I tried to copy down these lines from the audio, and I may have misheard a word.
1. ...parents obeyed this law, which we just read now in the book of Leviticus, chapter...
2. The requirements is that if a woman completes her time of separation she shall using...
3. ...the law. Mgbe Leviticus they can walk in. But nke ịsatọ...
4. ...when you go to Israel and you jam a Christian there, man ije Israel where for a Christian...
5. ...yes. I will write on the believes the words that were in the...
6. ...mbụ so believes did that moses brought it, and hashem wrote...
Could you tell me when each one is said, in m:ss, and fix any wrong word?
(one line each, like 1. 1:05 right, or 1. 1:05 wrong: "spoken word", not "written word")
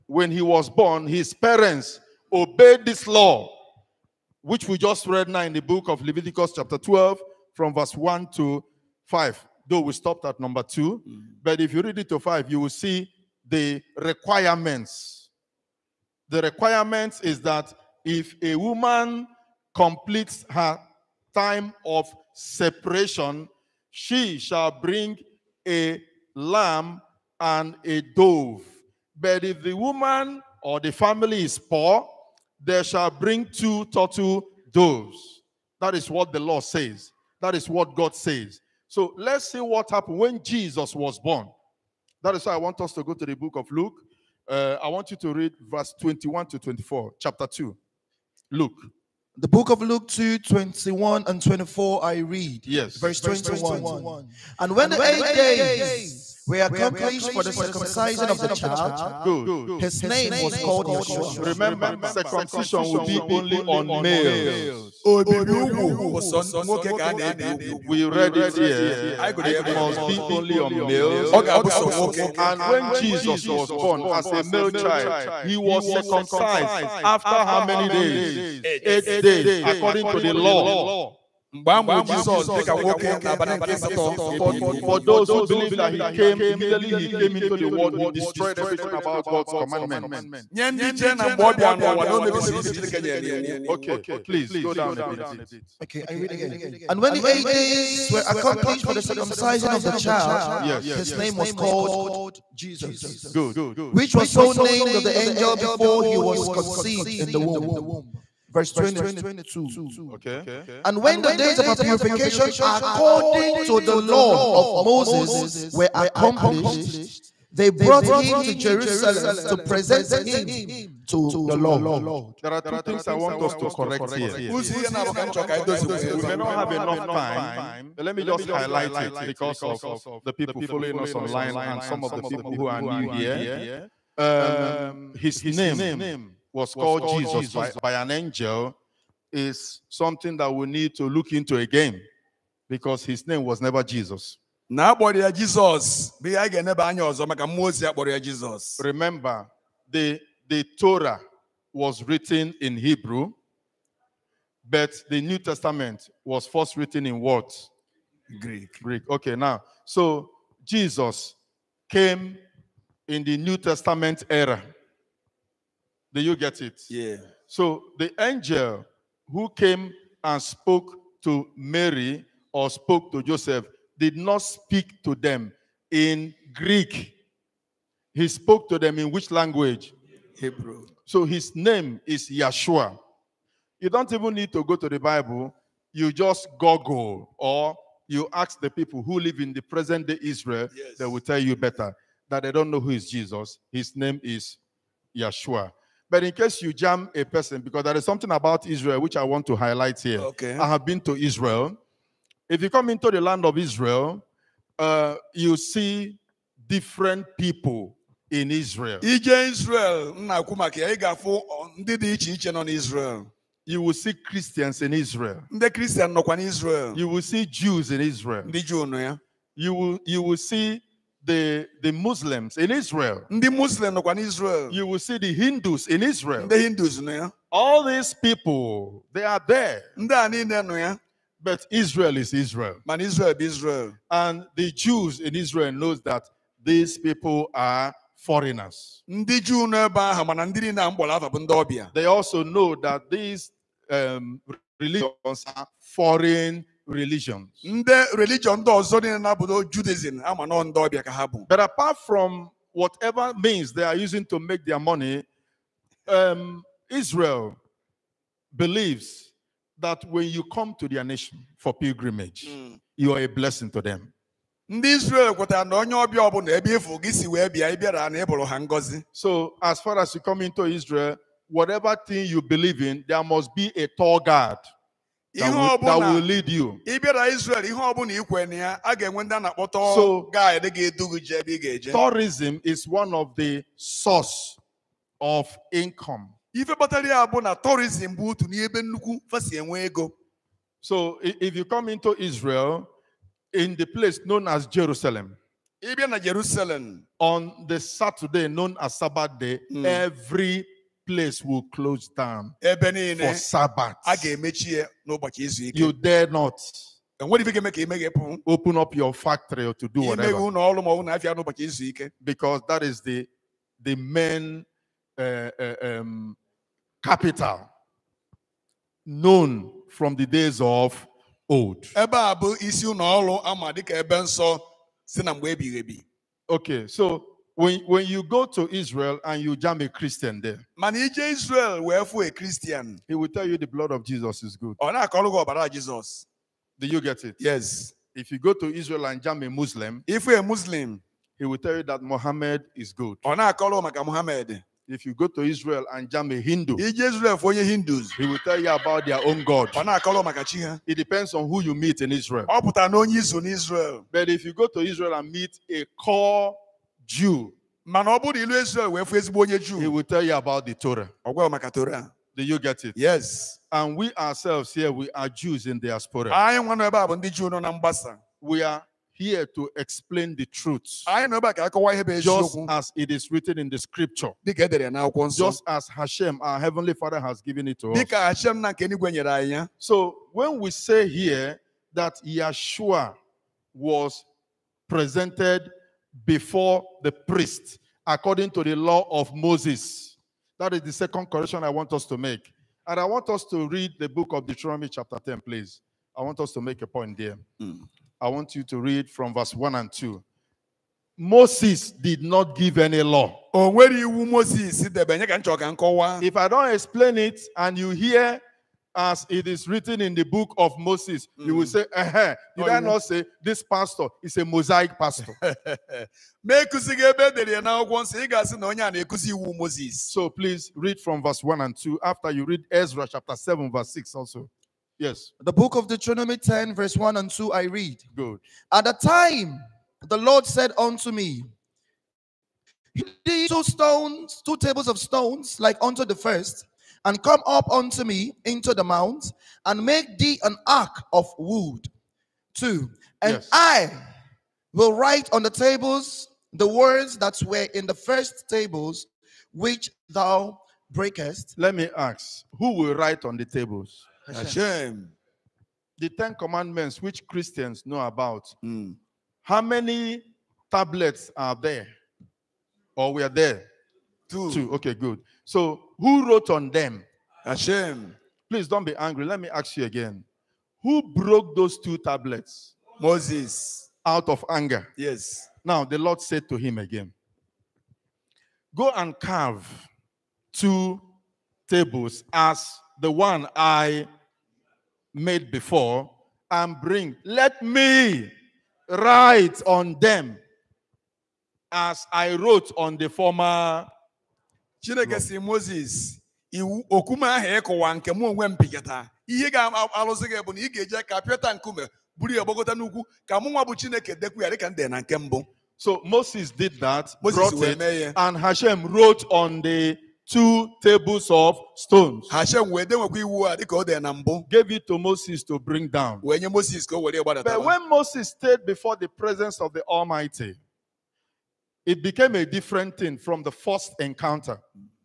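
1. 0:01 right
2. 0:16 wrong: "bring", not "using"
3. 1:20 wrong: "Jesus", not "Leviticus"
4. 5:27 right
5. 7:23 wrong: "tables", not "believes"
6. 8:25 wrong: "moses", not "believes".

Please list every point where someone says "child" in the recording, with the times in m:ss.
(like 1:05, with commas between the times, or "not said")
0:58, 1:14, 1:39.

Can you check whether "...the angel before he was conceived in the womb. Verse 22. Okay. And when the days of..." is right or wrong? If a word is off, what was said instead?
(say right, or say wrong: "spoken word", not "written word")
right.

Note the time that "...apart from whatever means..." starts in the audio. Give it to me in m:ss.
4:11.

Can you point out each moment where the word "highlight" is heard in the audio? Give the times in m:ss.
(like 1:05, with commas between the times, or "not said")
2:08, 3:19.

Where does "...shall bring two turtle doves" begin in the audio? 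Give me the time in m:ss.
0:32.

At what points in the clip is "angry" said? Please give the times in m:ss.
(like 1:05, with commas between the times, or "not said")
7:48.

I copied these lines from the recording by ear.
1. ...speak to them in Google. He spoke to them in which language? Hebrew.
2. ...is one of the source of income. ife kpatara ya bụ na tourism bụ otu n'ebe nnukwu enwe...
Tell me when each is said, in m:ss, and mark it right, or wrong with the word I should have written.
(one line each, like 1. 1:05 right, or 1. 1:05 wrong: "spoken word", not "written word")
1. 2:54 wrong: "Greek", not "Google"
2. 4:42 right.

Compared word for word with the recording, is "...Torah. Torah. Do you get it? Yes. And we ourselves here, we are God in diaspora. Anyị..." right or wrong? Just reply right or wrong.
wrong.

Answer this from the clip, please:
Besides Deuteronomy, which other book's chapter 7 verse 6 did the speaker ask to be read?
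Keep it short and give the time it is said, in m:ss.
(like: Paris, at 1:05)
Ezra, at 7:02.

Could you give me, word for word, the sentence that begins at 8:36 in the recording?
Wee nye Moses ka o were gbadata.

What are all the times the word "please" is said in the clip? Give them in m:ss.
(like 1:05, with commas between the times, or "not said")
1:34, 6:35, 7:00, 7:48.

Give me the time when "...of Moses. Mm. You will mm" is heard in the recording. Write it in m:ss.
6:50.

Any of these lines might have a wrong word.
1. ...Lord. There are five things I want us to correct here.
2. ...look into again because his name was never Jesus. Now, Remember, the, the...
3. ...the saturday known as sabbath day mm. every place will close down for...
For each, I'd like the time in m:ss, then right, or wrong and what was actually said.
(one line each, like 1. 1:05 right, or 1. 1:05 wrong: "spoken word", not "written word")
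1. 2:01 wrong: "two", not "five"
2. 2:21 right
3. 4:57 right.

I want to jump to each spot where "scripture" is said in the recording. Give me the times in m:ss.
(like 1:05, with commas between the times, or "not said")
6:13.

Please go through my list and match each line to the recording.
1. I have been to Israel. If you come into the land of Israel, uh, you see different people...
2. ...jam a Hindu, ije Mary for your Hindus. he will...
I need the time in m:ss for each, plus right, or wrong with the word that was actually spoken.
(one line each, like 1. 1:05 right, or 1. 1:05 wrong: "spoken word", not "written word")
1. 3:20 right
2. 5:46 wrong: "Israel", not "Mary".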